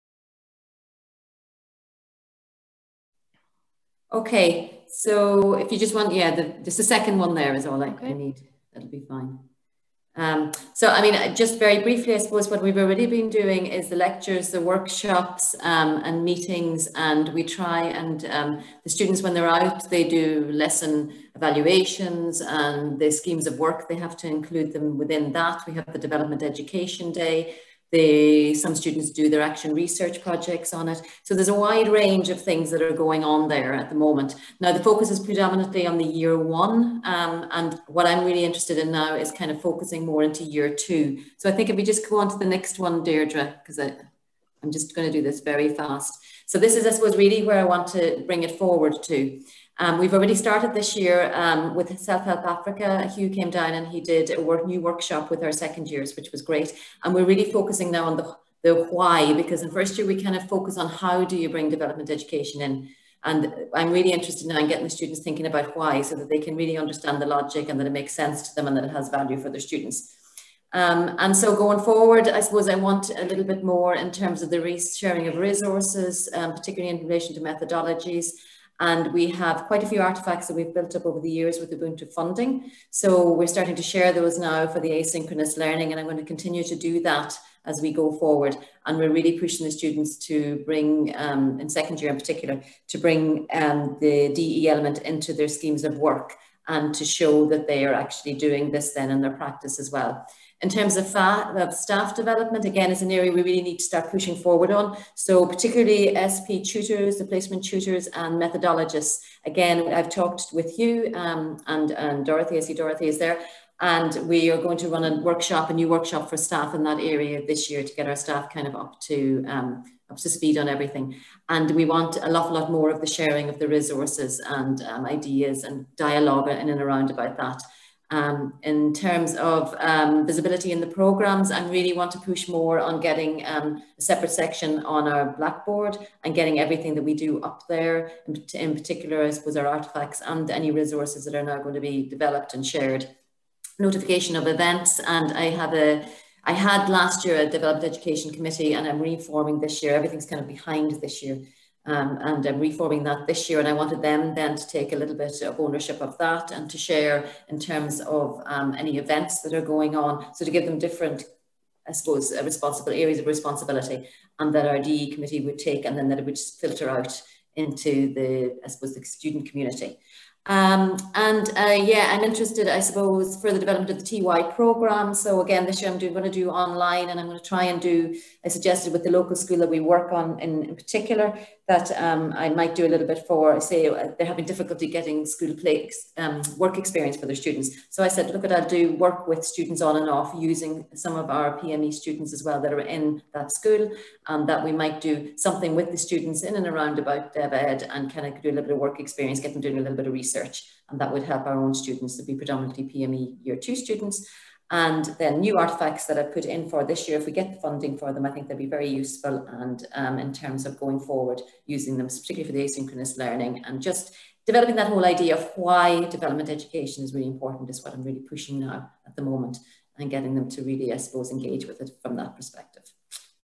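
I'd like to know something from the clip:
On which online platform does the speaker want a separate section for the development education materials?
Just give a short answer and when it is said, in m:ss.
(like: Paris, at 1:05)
Blackboard, at 2:15.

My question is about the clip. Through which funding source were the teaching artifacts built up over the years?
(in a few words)
Ubuntu.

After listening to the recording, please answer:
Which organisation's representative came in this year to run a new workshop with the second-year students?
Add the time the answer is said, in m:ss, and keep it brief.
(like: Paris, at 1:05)
Self Help Africa, at 0:51.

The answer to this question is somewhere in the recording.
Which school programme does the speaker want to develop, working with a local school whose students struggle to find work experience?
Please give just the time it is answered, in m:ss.
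2:54.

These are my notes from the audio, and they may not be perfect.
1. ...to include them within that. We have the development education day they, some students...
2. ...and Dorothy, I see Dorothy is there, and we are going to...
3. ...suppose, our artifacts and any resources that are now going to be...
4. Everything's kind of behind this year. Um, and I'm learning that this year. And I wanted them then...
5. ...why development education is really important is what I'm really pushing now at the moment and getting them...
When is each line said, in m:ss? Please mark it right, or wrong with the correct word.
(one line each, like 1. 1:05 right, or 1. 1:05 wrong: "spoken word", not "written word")
1. 0:24 right
2. 1:51 right
3. 2:19 right
4. 2:29 wrong: "reforming", not "learning"
5. 3:35 right.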